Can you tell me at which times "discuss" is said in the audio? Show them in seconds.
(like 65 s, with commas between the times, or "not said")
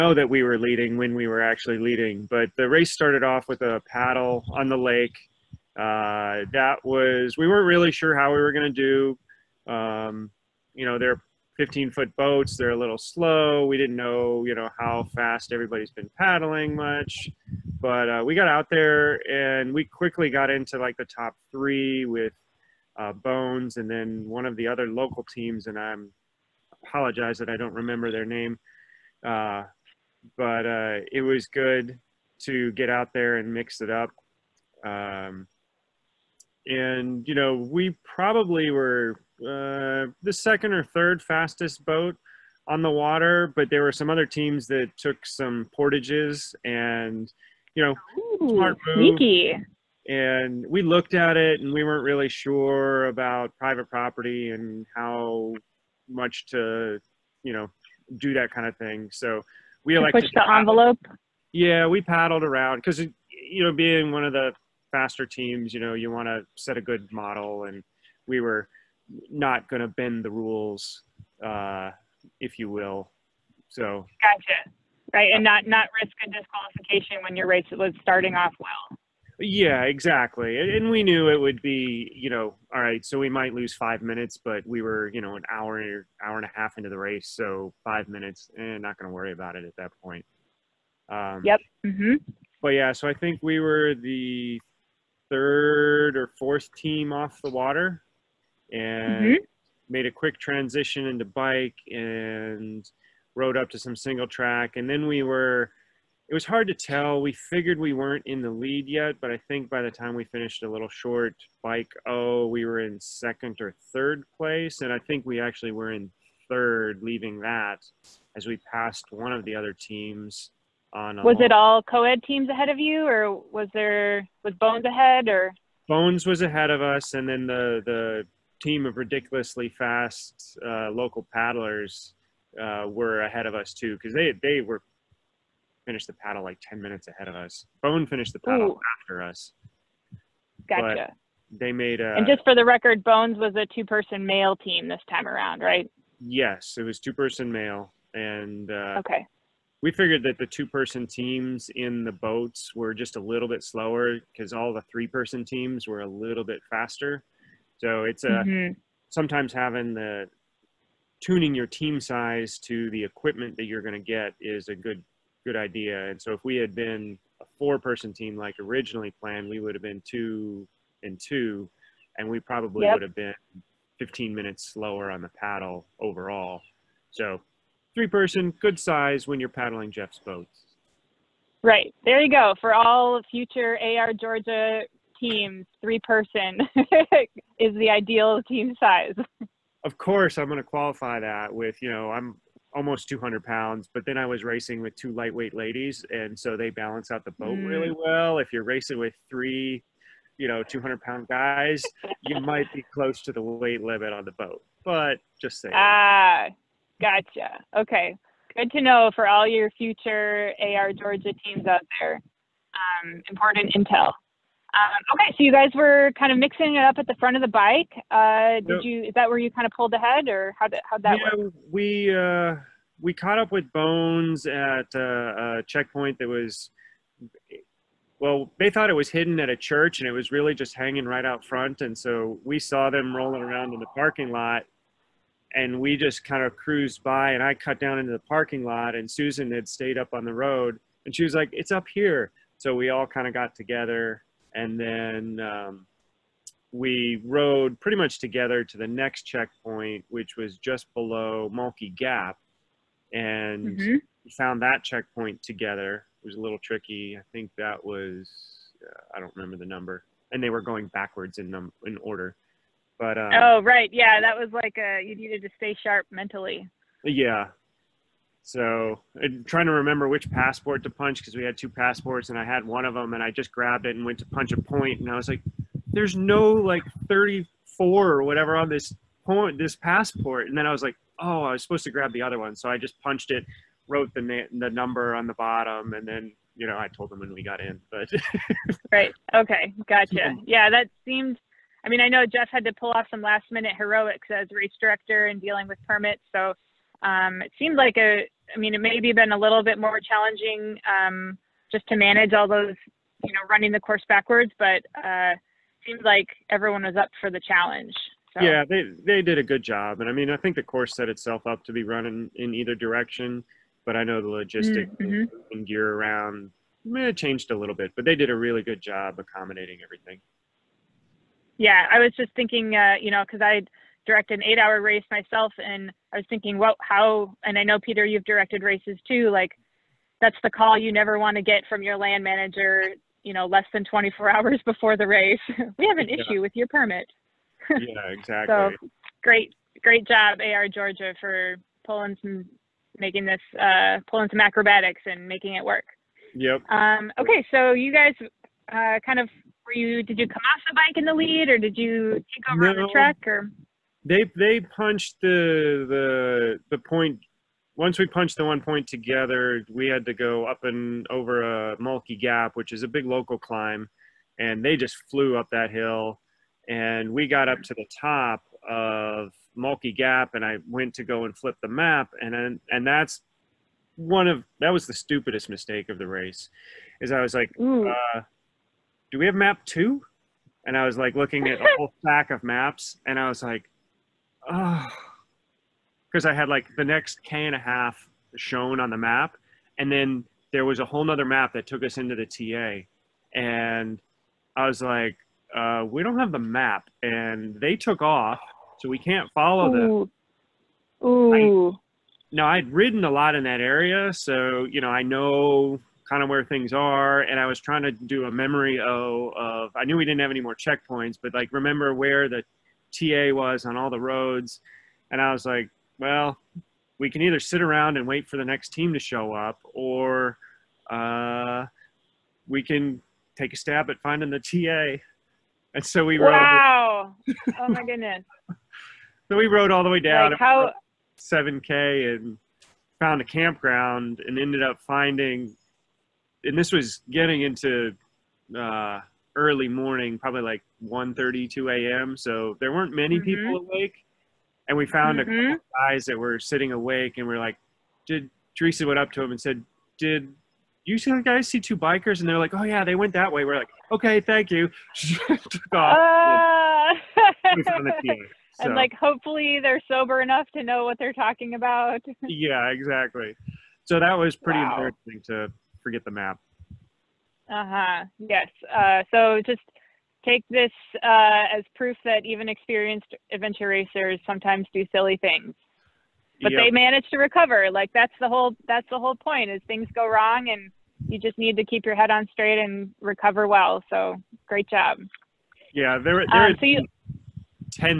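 not said.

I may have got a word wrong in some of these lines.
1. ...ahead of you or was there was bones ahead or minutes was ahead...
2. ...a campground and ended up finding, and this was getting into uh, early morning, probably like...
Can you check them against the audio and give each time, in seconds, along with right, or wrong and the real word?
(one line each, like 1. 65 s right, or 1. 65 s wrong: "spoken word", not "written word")
1. 122 s wrong: "bones", not "minutes"
2. 433 s right.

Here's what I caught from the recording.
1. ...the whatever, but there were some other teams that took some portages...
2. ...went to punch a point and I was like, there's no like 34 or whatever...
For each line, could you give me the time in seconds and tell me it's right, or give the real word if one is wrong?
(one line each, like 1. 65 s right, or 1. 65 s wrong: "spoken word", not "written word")
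1. 42 s wrong: "water", not "whatever"
2. 274 s right.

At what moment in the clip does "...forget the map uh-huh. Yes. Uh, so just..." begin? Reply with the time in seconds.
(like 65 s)
465 s.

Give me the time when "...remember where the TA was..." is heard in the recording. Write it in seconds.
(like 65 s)
411 s.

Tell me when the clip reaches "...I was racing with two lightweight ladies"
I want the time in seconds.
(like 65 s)
194 s.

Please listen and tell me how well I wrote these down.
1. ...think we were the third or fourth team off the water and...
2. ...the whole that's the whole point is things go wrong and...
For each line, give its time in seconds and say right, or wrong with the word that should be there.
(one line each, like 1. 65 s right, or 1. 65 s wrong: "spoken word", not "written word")
1. 93 s right
2. 478 s right.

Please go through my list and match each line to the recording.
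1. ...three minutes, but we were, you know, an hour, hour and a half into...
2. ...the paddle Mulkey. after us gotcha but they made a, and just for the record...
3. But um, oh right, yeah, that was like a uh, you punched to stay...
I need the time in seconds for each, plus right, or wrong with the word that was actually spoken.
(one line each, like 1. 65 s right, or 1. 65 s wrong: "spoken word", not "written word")
1. 83 s wrong: "five", not "three"
2. 138 s wrong: "Ooh", not "Mulkey"
3. 262 s wrong: "needed", not "punched".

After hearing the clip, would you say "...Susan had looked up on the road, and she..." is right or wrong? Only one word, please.
wrong.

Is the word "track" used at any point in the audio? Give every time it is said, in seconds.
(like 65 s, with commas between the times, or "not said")
104 s, 352 s.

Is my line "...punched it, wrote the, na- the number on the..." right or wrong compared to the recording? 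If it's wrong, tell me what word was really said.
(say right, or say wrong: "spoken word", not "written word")
right.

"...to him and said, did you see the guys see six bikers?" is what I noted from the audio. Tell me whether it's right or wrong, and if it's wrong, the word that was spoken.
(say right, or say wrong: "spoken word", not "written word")
wrong: "two", not "six".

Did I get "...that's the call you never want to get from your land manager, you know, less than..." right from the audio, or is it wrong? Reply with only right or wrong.
right.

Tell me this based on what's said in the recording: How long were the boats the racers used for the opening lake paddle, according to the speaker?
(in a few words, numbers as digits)
15 foot.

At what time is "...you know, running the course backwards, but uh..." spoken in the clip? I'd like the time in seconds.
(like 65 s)
303 s.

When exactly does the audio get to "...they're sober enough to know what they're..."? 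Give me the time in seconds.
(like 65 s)
459 s.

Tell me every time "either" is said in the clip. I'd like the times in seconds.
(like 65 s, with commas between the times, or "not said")
312 s, 417 s.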